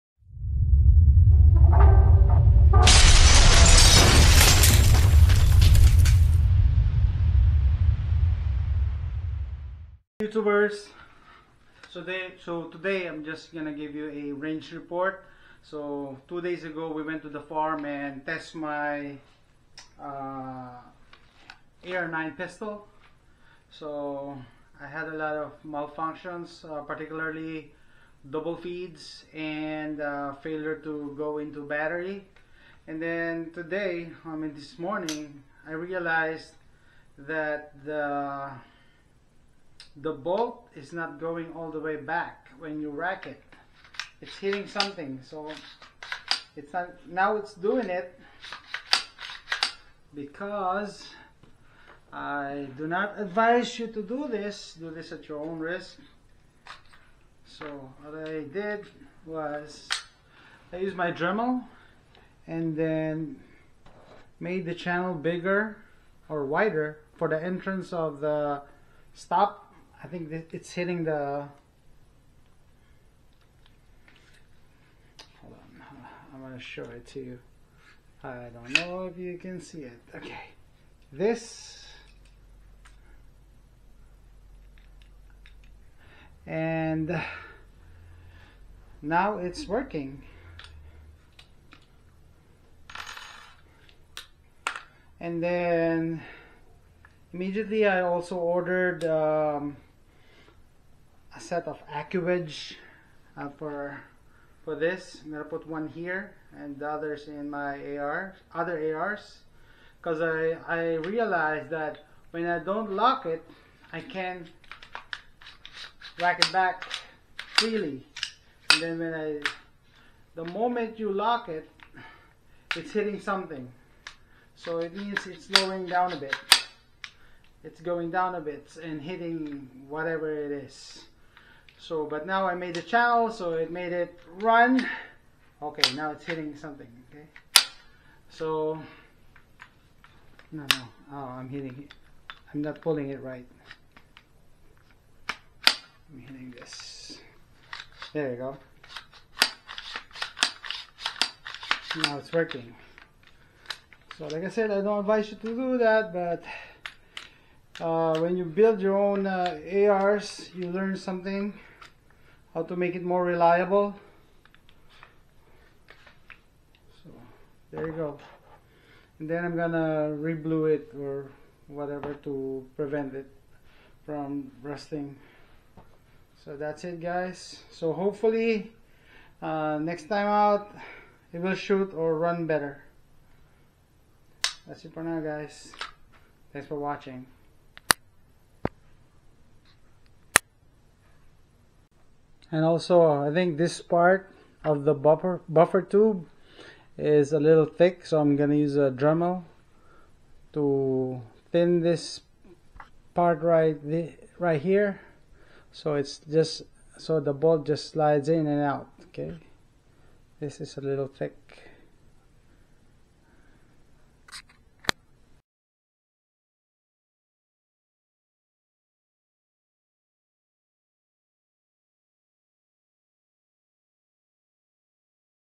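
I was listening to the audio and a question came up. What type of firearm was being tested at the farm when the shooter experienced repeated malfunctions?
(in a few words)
AR9 pistol.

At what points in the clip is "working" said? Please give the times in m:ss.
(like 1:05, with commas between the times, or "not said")
1:29, 2:32.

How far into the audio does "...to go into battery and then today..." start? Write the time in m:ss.
0:30.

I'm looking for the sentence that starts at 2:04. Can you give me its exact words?
So it means it's slowing down a bit.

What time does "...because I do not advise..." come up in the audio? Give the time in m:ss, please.
0:50.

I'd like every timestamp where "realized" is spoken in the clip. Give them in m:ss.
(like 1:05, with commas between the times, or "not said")
0:35, 1:50.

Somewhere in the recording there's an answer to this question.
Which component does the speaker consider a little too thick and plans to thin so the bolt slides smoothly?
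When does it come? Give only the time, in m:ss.
3:15.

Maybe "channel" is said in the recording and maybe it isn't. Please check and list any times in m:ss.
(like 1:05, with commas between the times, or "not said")
1:04, 2:12.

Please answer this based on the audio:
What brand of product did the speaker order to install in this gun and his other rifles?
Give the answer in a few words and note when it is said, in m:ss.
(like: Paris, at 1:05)
AccuWedge, at 1:41.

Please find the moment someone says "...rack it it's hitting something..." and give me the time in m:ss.
0:42.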